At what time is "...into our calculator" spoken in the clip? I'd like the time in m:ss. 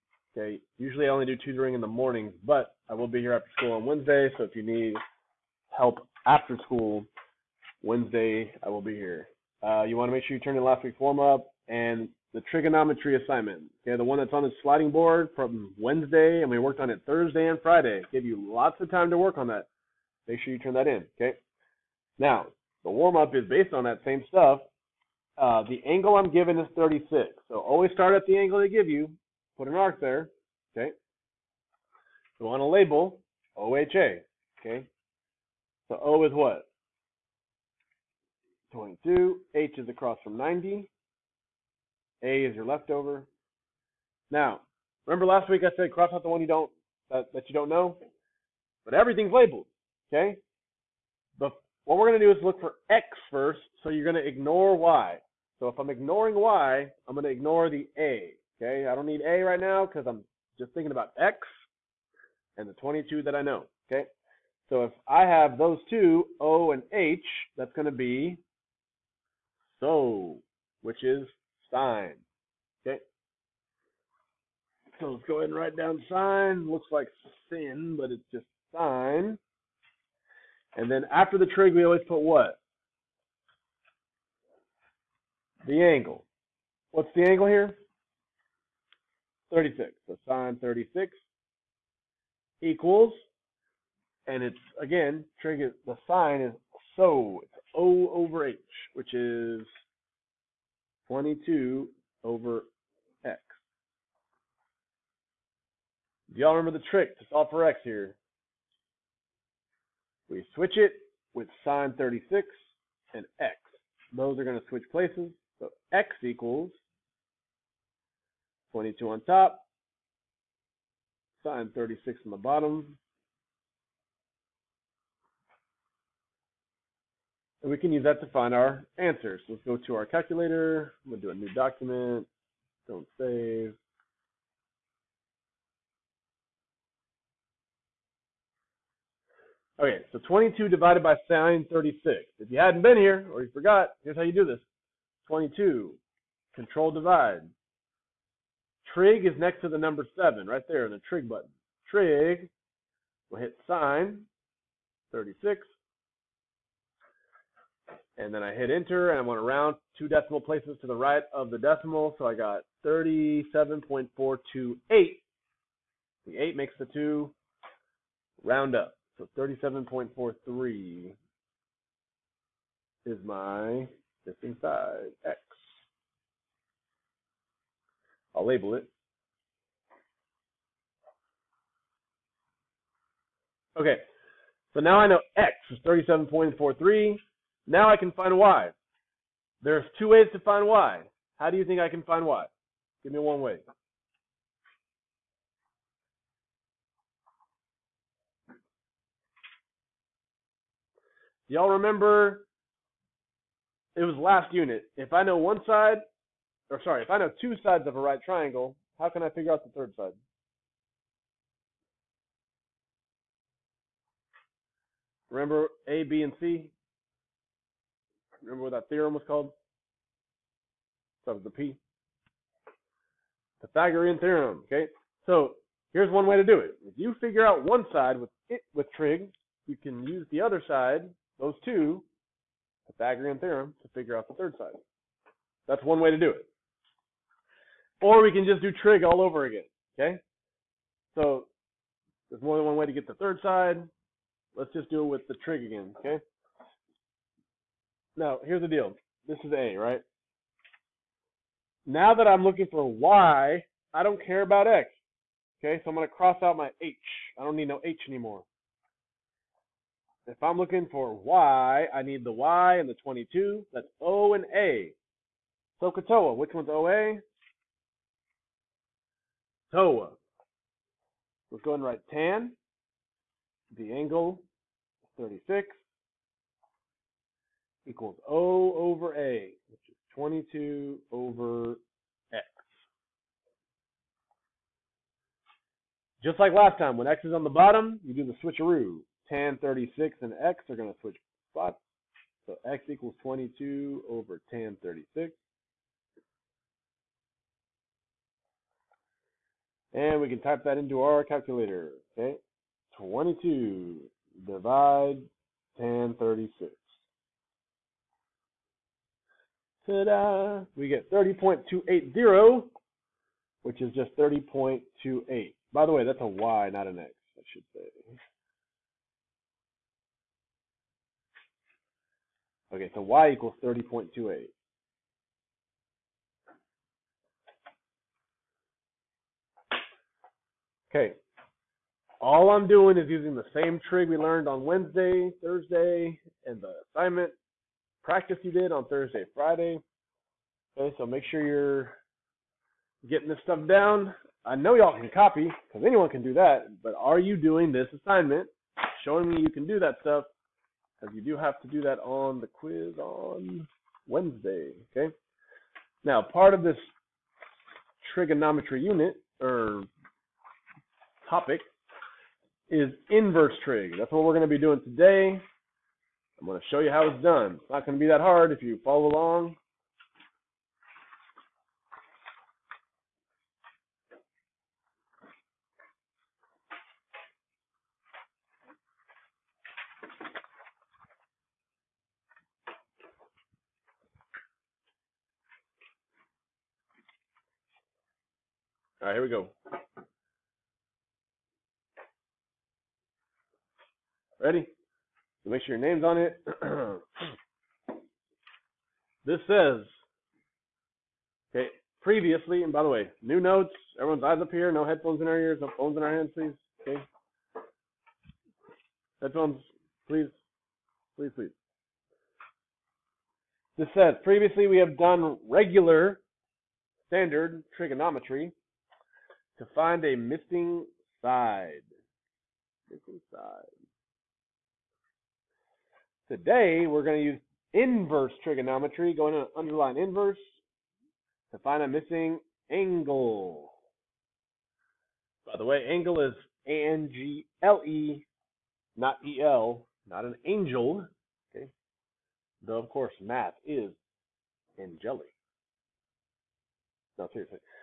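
5:00.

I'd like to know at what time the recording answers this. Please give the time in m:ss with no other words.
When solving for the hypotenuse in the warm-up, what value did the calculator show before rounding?
2:42.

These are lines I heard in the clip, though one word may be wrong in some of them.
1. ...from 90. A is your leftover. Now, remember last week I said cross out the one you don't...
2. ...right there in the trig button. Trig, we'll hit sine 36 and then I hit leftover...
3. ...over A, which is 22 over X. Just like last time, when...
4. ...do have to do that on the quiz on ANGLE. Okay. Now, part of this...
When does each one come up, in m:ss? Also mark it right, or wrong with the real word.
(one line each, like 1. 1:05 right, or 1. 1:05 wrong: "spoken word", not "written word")
1. 0:40 right
2. 2:30 wrong: "enter", not "leftover"
3. 4:38 right
4. 5:51 wrong: "Wednesday", not "ANGLE".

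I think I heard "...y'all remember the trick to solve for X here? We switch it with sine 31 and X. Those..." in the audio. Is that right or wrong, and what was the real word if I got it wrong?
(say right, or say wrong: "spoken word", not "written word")
wrong: "36", not "31".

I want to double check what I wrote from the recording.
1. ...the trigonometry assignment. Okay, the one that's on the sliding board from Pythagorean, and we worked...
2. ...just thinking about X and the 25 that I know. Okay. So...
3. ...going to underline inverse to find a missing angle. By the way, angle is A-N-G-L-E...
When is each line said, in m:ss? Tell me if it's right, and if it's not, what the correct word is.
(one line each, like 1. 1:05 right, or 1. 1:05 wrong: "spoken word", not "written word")
1. 0:12 wrong: "Wednesday", not "Pythagorean"
2. 1:00 wrong: "22", not "25"
3. 7:09 right.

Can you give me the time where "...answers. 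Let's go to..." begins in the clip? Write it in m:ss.
2:08.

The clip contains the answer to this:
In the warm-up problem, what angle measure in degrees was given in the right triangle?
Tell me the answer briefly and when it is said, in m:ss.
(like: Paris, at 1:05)
36, at 0:25.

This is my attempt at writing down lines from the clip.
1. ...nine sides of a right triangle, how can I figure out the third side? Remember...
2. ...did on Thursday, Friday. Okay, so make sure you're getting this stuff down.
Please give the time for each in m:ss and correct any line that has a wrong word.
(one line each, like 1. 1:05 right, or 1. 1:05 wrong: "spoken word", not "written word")
1. 3:27 wrong: "two", not "nine"
2. 5:38 right.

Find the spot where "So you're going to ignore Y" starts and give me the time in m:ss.
0:53.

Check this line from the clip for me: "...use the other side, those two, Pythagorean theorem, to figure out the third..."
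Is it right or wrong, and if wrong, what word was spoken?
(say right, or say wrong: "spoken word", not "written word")
right.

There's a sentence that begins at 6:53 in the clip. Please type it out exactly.
This says, previously we have done regular standard trigonometry to find a missing side.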